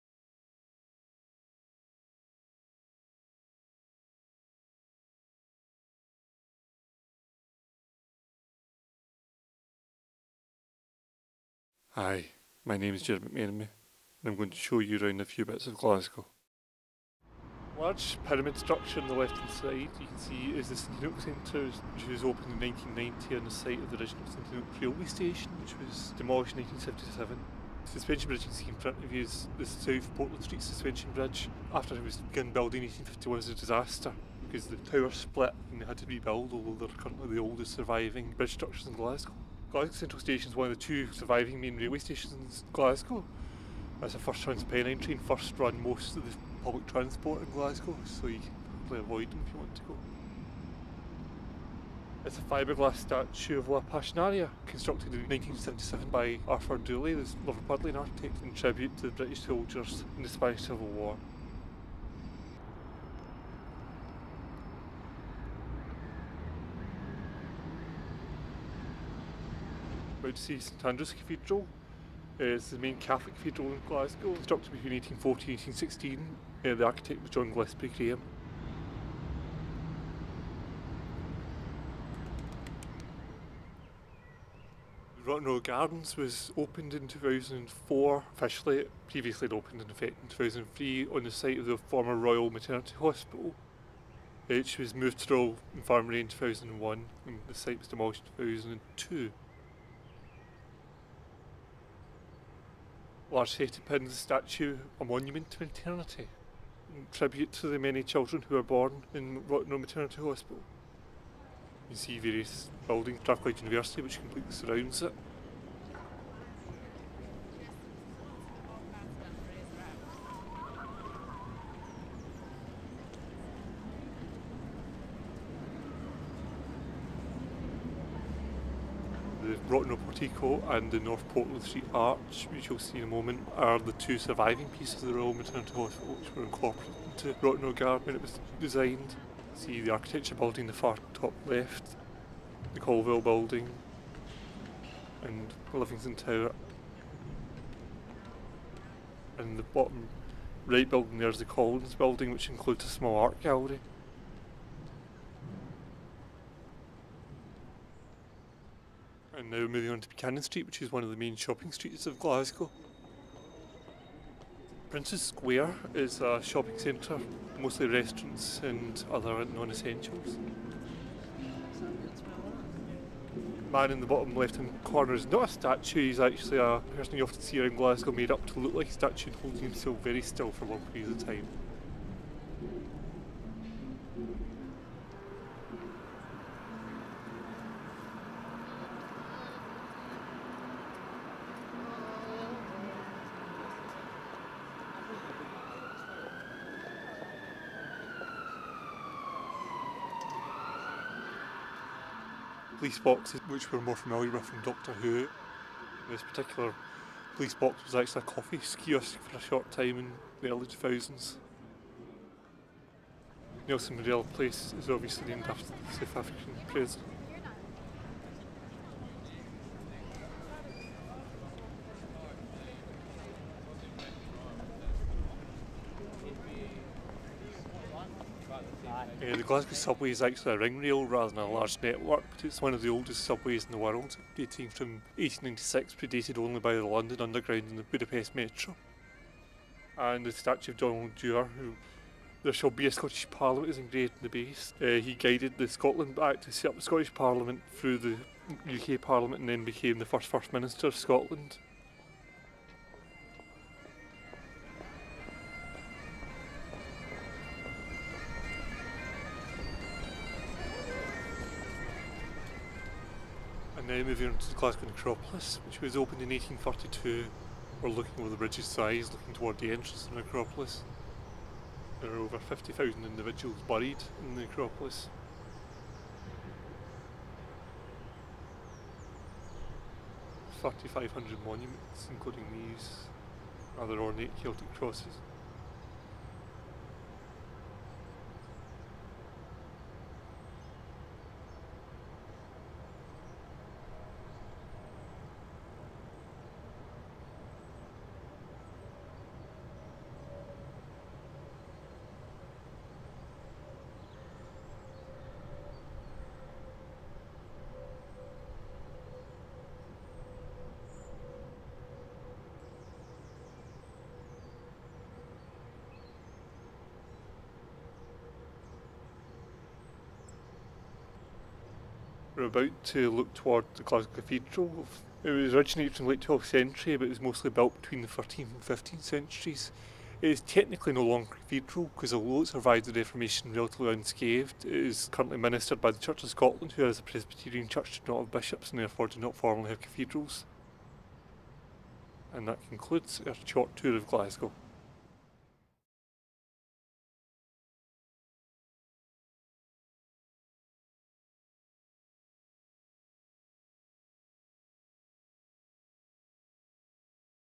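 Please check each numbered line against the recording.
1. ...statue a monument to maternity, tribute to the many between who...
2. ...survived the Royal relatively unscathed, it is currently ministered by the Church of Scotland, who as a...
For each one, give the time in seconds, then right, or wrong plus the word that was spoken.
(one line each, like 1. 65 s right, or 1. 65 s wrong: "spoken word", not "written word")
1. 104 s wrong: "children", not "between"
2. 332 s wrong: "Reformation", not "Royal".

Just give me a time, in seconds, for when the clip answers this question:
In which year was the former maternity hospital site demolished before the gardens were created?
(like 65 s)
98 s.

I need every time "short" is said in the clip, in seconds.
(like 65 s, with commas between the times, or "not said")
209 s, 343 s.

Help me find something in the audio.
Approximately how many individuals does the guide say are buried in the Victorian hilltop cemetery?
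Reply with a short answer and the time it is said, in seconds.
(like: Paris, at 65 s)
over 50,000, at 272 s.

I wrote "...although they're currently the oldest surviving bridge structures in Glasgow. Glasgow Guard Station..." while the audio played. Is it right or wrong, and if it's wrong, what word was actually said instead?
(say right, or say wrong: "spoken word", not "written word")
wrong: "Central", not "Guard".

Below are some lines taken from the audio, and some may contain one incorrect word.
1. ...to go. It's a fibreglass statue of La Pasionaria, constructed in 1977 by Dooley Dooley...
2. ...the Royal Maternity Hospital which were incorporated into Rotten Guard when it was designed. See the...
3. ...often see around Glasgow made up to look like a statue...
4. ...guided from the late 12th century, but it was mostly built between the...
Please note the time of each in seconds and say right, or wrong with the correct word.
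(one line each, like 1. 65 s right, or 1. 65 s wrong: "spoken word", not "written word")
1. 49 s wrong: "Arthur", not "Dooley"
2. 135 s right
3. 177 s right
4. 325 s wrong: "originated", not "guided".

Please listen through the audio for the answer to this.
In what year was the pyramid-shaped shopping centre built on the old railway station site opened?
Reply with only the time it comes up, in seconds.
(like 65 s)
22 s.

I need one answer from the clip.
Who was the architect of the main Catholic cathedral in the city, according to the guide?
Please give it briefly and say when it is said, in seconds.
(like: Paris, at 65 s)
John Gillespie Graham, at 77 s.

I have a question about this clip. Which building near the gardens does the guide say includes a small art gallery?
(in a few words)
the Collins building.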